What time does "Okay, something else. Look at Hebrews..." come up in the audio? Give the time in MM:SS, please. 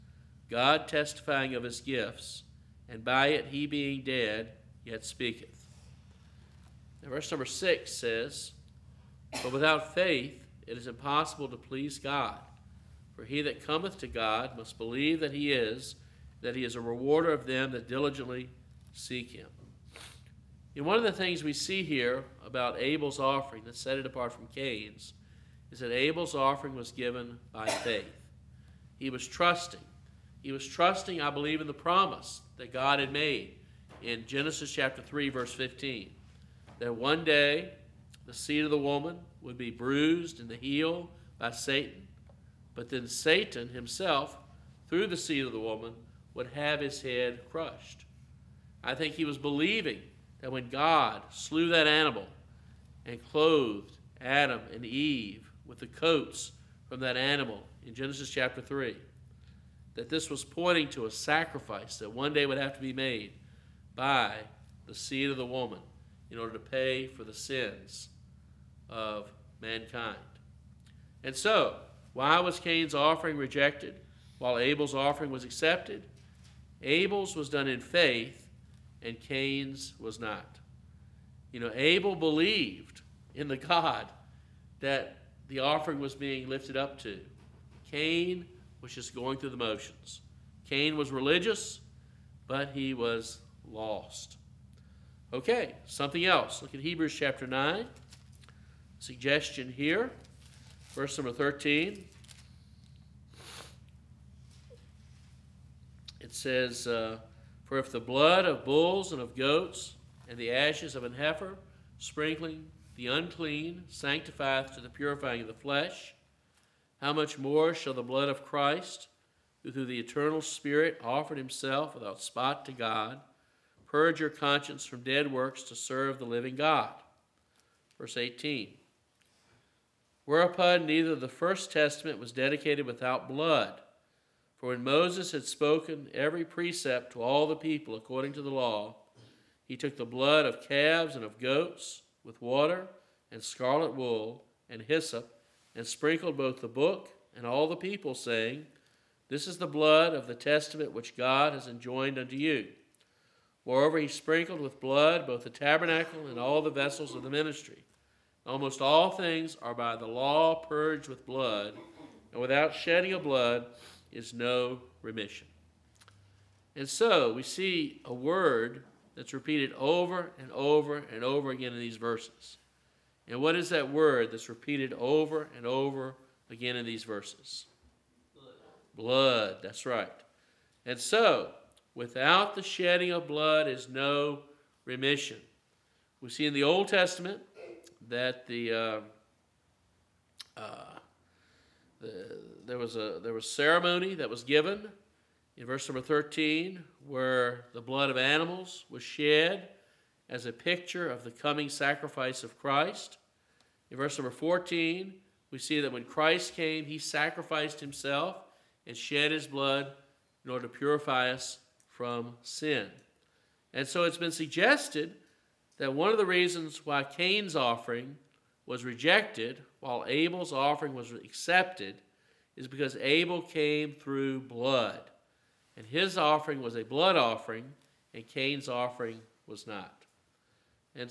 01:35.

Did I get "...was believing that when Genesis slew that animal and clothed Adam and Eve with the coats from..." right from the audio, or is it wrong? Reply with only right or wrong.
wrong.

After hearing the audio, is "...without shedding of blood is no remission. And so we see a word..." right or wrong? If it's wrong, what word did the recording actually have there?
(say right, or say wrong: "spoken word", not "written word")
right.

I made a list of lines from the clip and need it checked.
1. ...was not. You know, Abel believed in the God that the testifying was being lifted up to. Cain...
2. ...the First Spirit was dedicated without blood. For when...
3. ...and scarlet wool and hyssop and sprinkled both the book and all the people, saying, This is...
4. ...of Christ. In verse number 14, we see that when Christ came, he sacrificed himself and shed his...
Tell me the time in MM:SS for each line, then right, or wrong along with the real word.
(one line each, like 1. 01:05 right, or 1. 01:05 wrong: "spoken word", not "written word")
1. 01:19 wrong: "offering", not "testifying"
2. 02:11 wrong: "Testament", not "Spirit"
3. 02:23 right
4. 03:22 right.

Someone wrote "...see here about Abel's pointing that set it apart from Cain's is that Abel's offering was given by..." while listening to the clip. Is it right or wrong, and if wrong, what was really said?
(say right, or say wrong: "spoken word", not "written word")
wrong: "offering", not "pointing".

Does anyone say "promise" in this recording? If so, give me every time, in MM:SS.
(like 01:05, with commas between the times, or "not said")
00:31.